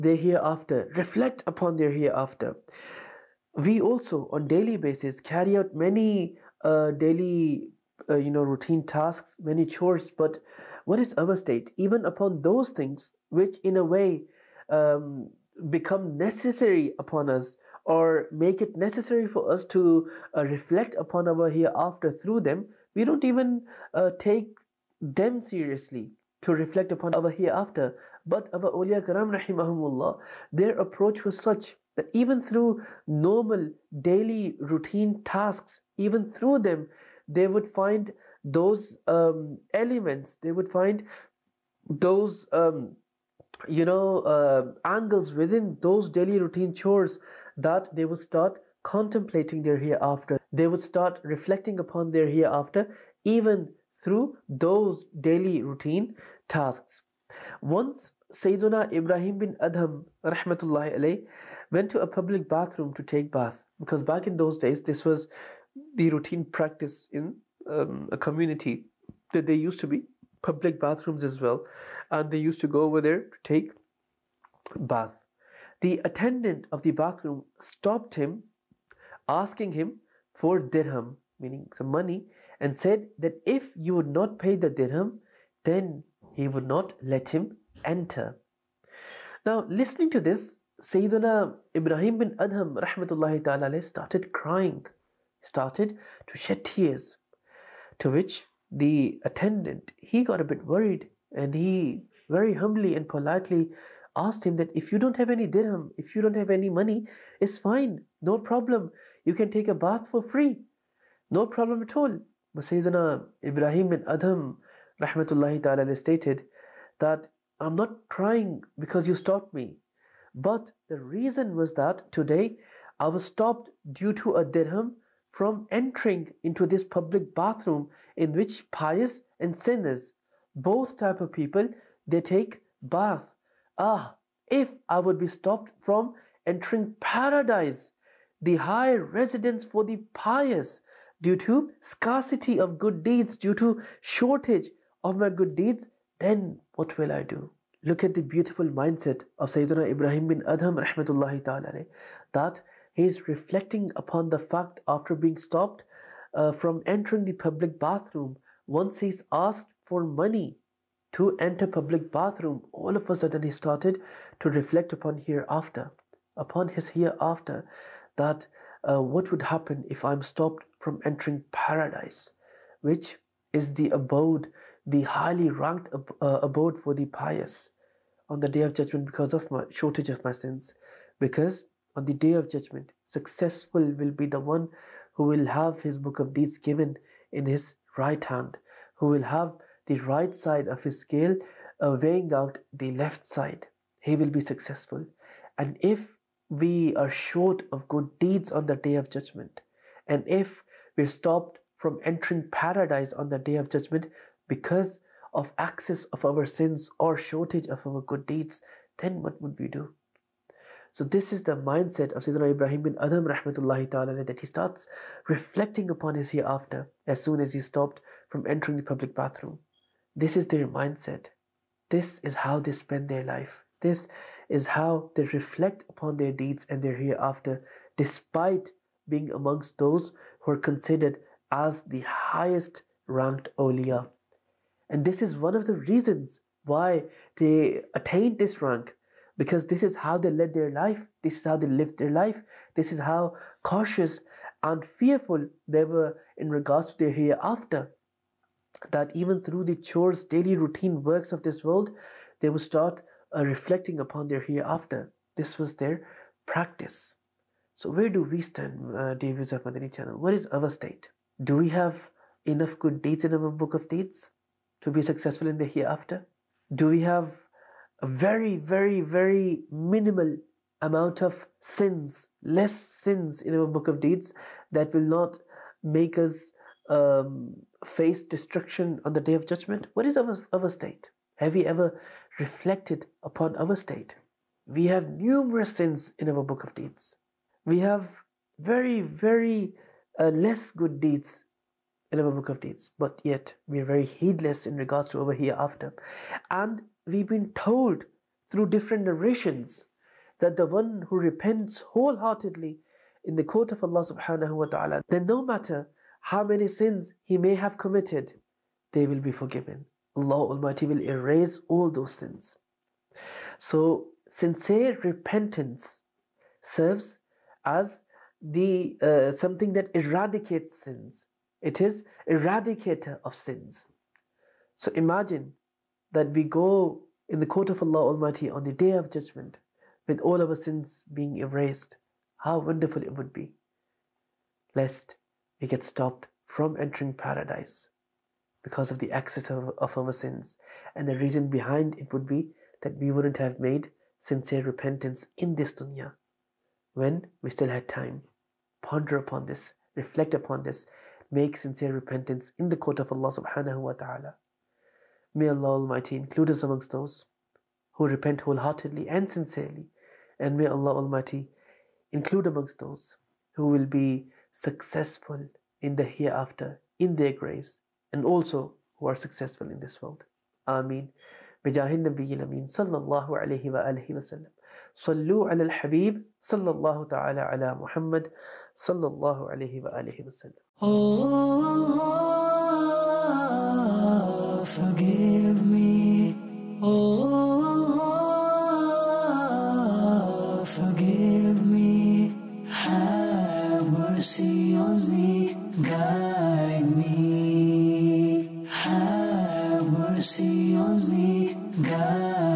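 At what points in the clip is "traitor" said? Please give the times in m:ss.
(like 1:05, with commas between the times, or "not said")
not said.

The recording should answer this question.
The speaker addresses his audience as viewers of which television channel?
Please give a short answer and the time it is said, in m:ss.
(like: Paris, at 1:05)
Madani channel, at 4:19.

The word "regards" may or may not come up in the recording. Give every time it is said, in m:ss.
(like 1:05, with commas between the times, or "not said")
4:06, 4:54.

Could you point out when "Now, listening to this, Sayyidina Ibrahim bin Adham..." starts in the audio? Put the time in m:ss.
1:29.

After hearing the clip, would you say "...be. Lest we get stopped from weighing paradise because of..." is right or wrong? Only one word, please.
wrong.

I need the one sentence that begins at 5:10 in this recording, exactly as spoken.
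Allah Almighty will erase all those sins.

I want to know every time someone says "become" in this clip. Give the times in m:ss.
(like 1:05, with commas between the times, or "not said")
0:15.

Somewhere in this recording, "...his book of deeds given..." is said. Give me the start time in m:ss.
3:05.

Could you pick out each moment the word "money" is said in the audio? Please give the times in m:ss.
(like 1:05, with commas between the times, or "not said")
1:21, 1:46, 2:40.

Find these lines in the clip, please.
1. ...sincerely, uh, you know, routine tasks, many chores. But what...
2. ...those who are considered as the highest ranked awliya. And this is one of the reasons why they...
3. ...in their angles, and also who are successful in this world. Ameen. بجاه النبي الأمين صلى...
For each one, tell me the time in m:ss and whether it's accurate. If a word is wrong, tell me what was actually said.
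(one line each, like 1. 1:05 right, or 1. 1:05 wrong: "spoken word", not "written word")
1. 0:06 wrong: "daily", not "sincerely"
2. 3:49 right
3. 6:06 wrong: "graves", not "angles".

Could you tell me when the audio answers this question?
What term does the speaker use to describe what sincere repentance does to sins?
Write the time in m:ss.
5:22.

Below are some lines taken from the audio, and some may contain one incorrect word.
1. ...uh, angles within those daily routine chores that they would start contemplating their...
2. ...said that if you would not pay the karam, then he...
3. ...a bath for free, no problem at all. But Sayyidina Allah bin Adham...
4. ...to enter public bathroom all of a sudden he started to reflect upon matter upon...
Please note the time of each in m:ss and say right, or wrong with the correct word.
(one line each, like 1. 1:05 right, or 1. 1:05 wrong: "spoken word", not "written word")
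1. 0:44 right
2. 1:22 wrong: "dirham", not "karam"
3. 1:49 wrong: "Ibrahim", not "Allah"
4. 2:41 wrong: "hereafter", not "matter".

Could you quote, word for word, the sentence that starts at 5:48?
Ponder upon this, reflect upon this, make sincere repentance in the court of Allah subhanahu wa ta'ala.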